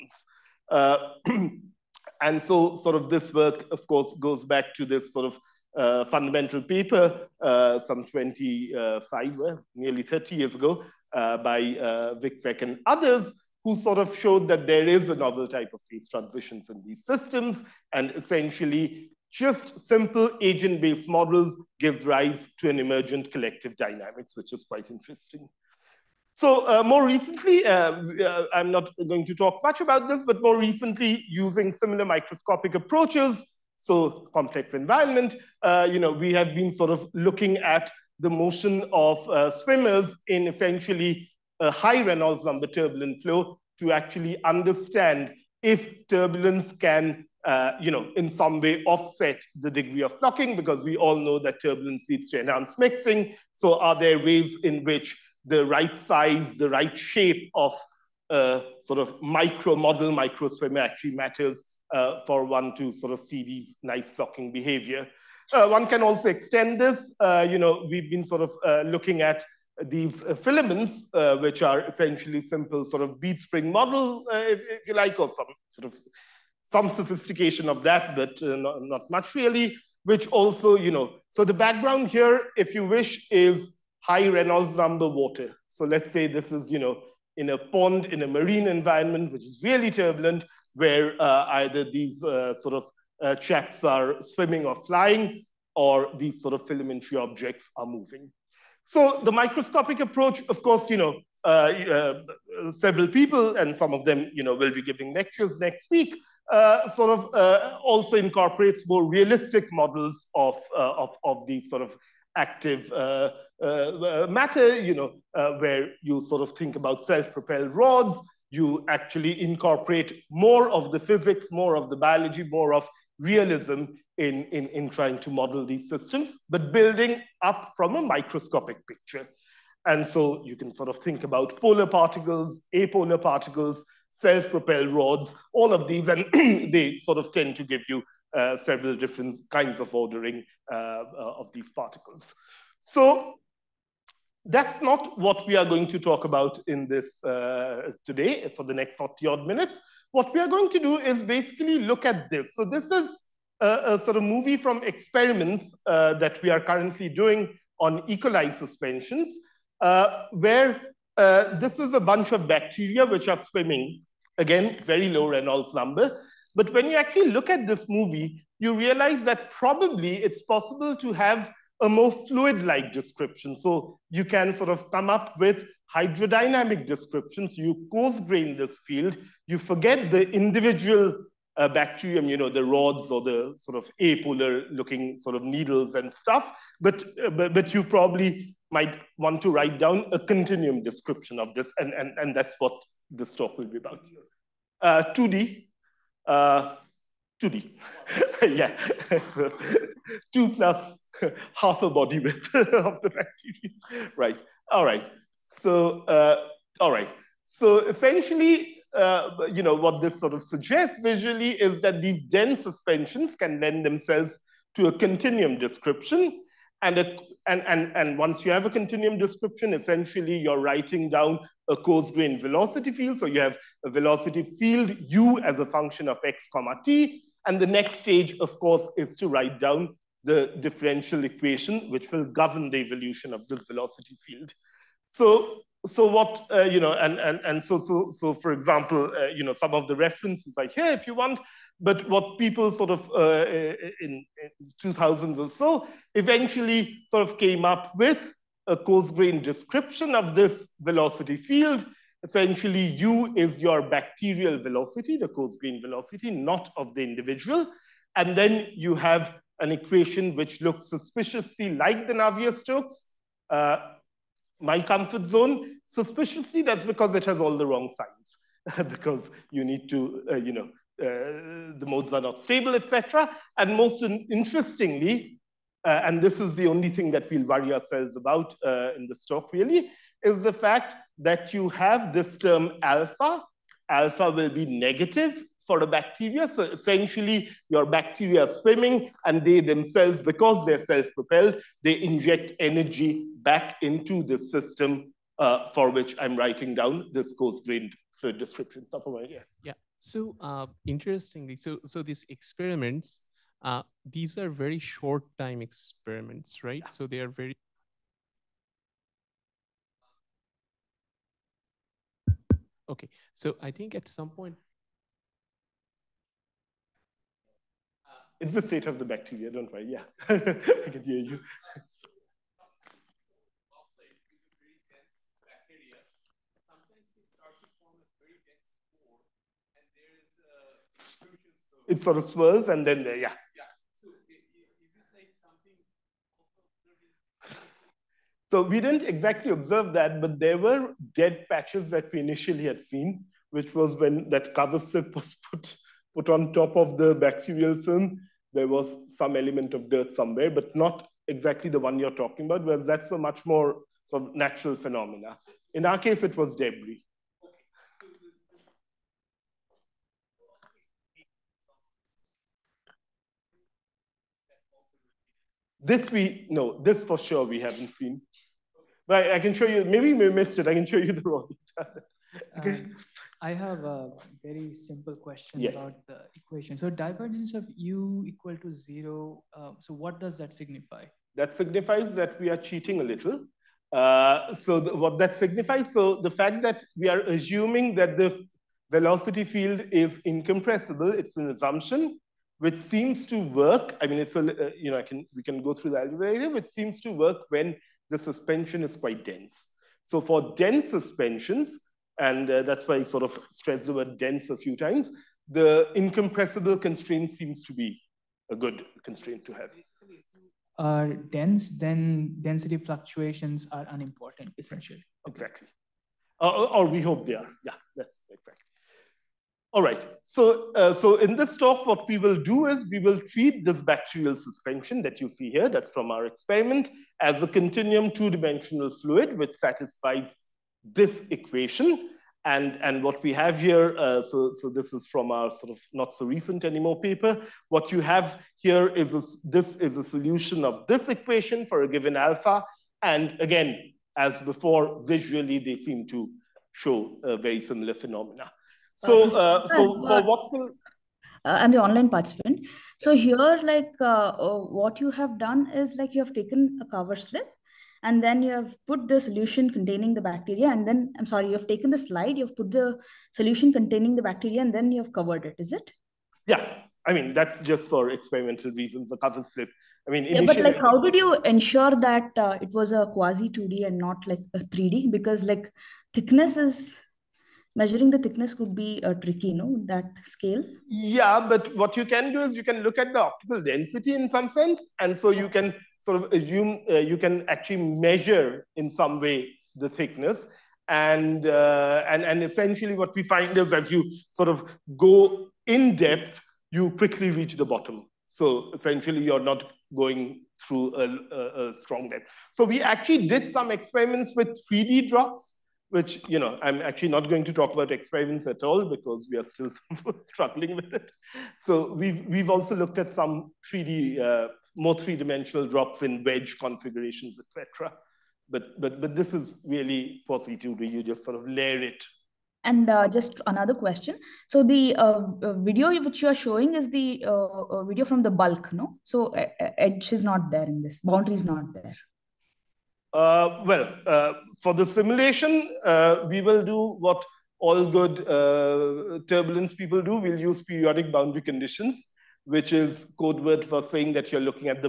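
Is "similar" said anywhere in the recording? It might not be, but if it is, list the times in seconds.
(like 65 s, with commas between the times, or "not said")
31 s, 447 s.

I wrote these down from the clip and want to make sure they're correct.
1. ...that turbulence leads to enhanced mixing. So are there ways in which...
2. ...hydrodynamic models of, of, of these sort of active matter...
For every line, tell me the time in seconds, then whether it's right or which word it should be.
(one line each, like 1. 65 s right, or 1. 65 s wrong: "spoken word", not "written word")
1. 51 s right
2. 109 s wrong: "realistic", not "hydrodynamic".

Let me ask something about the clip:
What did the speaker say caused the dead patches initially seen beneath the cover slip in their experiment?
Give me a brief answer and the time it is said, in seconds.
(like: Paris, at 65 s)
debris, at 356 s.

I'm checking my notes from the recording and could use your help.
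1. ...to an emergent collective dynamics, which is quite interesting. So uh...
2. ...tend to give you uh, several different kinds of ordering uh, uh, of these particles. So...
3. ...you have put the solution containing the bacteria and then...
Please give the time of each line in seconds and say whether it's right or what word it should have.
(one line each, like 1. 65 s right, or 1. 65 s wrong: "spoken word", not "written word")
1. 22 s right
2. 137 s right
3. 458 s right.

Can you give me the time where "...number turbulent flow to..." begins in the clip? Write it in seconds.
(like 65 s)
42 s.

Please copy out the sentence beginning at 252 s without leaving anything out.
Essentially, u is your bacterial velocity, the coarse grain velocity, not of the individual.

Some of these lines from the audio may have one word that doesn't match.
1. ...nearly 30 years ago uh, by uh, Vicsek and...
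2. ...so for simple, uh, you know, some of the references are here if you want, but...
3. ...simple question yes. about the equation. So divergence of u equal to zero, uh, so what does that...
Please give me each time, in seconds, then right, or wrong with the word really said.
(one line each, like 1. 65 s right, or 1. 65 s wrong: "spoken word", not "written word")
1. 9 s right
2. 238 s wrong: "example", not "simple"
3. 374 s right.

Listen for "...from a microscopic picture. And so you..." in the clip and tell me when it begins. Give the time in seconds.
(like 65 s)
127 s.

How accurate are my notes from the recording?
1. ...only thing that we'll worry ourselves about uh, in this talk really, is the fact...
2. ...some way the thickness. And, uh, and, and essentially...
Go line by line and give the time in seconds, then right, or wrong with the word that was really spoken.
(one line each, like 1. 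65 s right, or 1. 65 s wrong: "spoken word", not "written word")
1. 276 s right
2. 488 s right.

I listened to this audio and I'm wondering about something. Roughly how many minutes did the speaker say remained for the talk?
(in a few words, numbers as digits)
40.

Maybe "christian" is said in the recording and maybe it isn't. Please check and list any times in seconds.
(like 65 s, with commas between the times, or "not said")
not said.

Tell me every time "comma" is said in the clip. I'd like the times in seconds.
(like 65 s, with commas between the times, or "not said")
226 s.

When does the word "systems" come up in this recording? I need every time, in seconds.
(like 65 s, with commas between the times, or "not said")
17 s, 125 s, 294 s.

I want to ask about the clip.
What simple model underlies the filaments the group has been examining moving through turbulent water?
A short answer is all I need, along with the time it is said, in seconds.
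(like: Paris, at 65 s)
bead spring model, at 73 s.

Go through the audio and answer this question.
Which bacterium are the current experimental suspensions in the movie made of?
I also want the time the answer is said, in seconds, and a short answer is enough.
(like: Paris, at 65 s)
E. coli, at 158 s.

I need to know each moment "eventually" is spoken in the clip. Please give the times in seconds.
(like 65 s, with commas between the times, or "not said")
246 s.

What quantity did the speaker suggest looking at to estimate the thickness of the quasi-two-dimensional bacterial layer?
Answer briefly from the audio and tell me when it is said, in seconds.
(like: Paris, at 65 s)
optical density, at 483 s.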